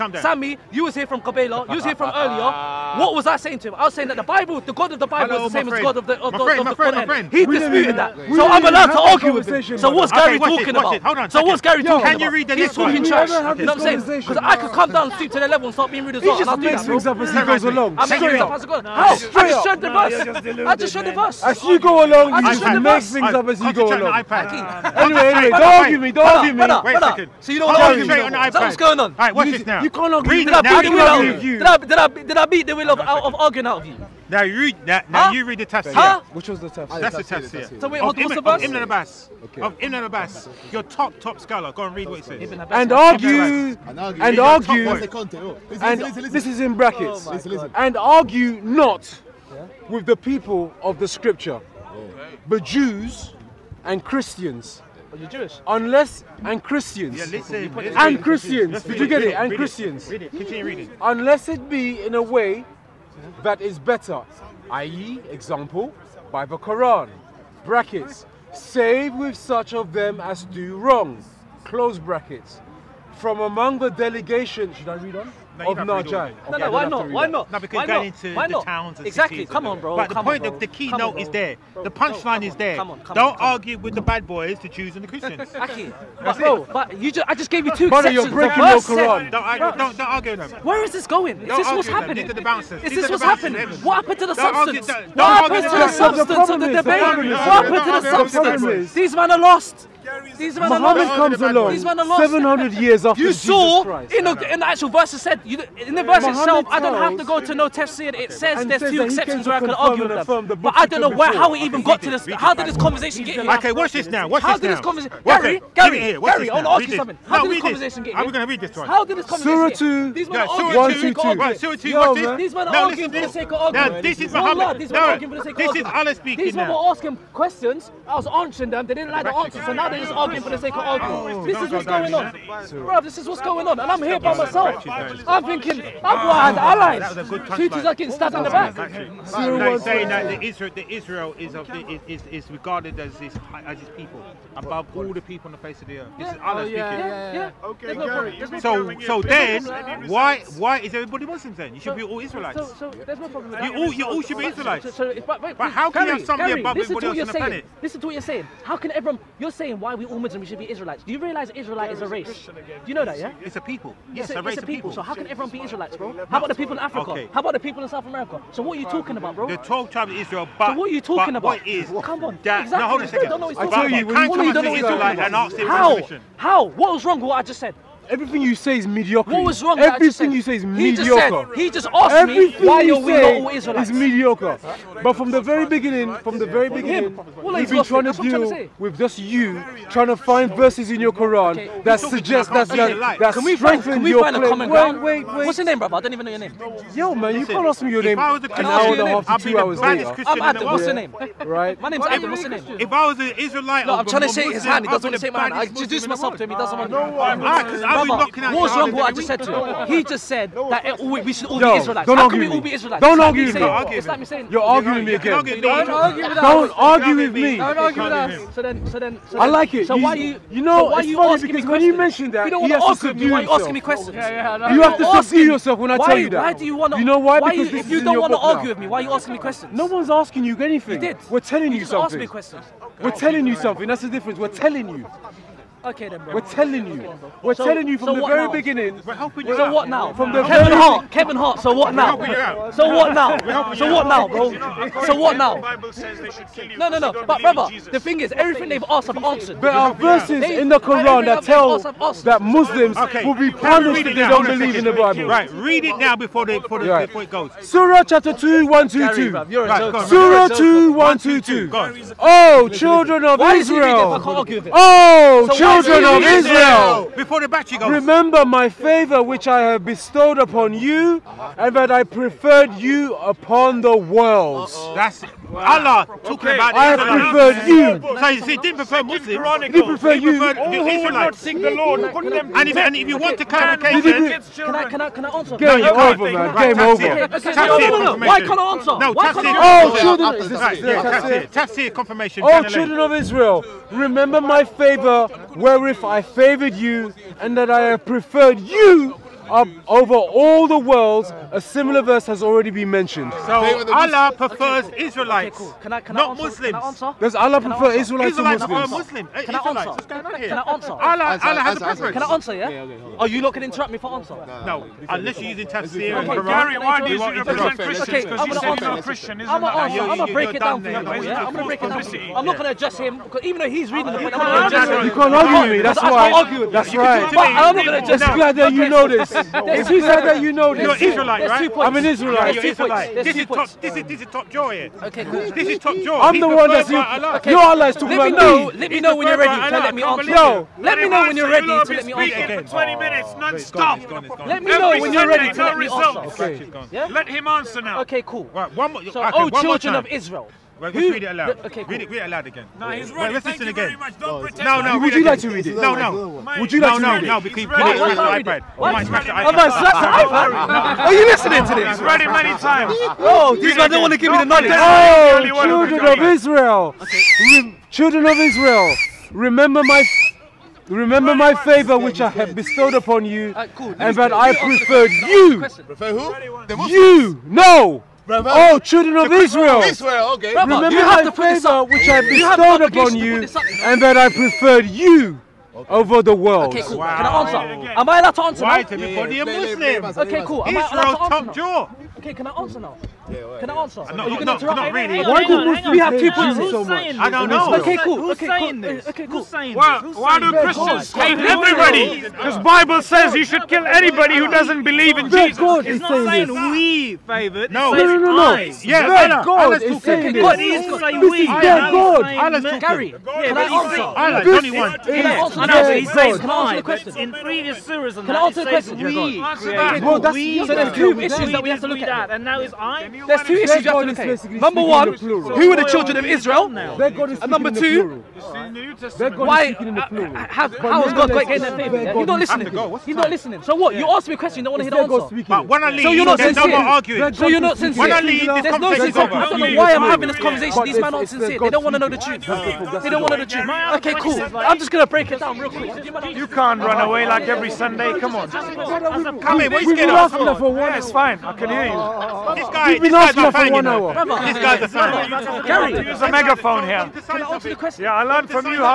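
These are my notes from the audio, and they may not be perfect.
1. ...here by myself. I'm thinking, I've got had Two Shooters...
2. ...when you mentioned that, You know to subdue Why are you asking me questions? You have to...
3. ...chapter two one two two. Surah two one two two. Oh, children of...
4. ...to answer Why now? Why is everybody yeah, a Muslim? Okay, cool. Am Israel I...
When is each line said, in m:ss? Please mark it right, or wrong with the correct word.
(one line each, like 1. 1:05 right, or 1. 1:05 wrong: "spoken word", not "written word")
1. 2:14 right
2. 3:41 right
3. 4:18 right
4. 6:28 right.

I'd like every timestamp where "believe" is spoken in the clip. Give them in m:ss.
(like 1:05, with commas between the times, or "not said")
4:14, 6:44.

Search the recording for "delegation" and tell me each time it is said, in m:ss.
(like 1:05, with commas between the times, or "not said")
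1:13.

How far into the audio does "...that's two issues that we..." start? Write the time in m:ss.
7:00.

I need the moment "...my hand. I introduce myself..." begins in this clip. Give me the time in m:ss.
3:25.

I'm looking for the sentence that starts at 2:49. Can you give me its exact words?
The 12 tribes of Israel, but so what are you talking about?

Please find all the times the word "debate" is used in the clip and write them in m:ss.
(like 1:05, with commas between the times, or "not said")
1:36.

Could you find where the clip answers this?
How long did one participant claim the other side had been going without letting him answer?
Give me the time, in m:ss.
5:42.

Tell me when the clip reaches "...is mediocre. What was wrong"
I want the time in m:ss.
2:58.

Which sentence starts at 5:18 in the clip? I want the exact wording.
Because you said you're not Christian, isn't it?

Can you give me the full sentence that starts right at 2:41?
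Do you realize Israelite is a race?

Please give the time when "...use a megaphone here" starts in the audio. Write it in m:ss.
7:36.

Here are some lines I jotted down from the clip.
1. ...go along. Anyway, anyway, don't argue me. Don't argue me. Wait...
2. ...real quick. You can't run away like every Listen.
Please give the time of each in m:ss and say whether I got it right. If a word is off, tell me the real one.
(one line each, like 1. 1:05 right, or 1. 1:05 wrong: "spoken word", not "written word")
1. 0:23 right
2. 7:25 wrong: "Sunday", not "Listen".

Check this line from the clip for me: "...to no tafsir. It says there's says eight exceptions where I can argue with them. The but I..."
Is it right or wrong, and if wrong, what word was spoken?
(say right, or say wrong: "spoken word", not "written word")
wrong: "two", not "eight".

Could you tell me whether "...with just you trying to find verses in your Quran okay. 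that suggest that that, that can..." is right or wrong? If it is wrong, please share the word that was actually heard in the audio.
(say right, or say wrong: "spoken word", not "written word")
right.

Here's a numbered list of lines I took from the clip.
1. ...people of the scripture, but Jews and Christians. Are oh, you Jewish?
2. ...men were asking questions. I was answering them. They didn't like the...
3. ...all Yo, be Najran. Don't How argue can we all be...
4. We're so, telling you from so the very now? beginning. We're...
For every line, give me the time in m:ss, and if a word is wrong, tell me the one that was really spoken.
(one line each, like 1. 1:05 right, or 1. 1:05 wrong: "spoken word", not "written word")
1. 0:50 right
2. 2:06 right
3. 3:31 wrong: "Israelites", not "Najran"
4. 3:57 right.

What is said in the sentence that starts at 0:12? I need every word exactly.
Can you read the He's talking trash.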